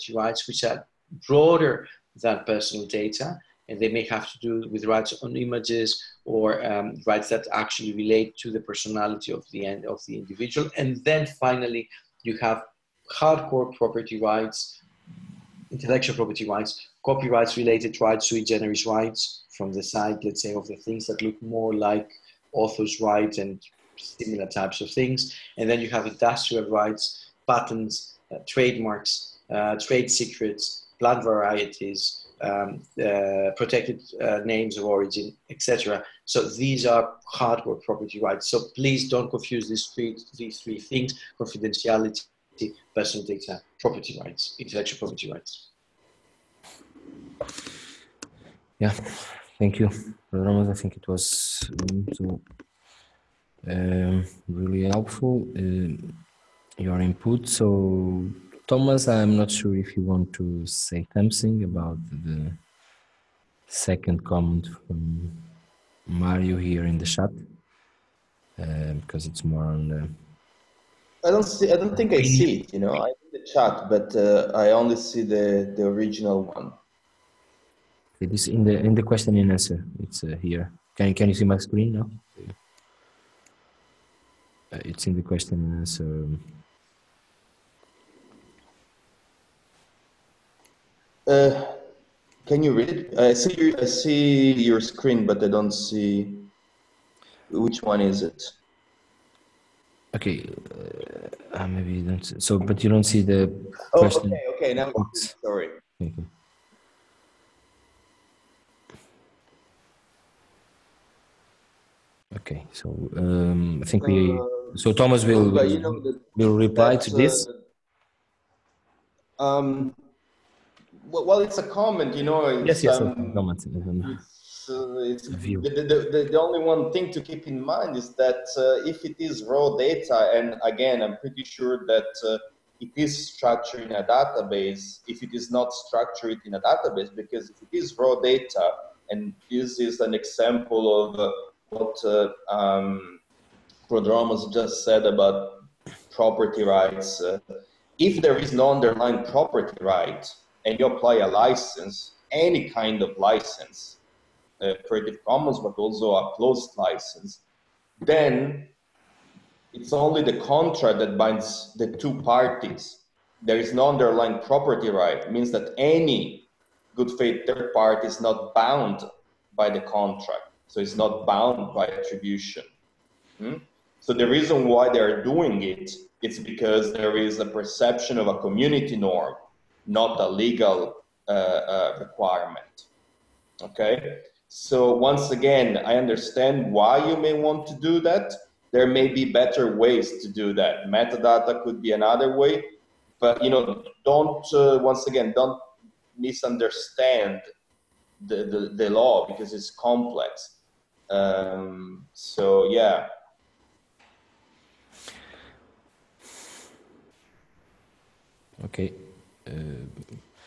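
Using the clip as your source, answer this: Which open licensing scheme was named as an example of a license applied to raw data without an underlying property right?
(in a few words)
Creative Commons.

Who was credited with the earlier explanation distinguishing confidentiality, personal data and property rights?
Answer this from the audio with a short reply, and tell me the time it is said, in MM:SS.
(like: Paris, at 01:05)
Prodromos, at 02:23.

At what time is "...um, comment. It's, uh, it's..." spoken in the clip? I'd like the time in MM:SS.
02:03.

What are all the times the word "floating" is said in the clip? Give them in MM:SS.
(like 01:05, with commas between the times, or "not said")
not said.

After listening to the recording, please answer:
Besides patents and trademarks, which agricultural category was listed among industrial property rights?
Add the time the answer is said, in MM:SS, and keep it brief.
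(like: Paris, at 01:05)
plant varieties, at 00:30.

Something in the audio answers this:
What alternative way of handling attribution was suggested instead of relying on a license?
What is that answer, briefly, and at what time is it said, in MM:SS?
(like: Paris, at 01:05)
Metadata, at 03:10.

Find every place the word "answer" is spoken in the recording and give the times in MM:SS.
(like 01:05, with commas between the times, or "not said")
01:19, 01:25.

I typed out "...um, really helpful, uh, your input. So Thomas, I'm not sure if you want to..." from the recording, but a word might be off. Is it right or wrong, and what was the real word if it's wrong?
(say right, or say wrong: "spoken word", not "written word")
right.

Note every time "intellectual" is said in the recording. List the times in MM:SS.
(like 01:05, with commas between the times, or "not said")
00:15, 00:44.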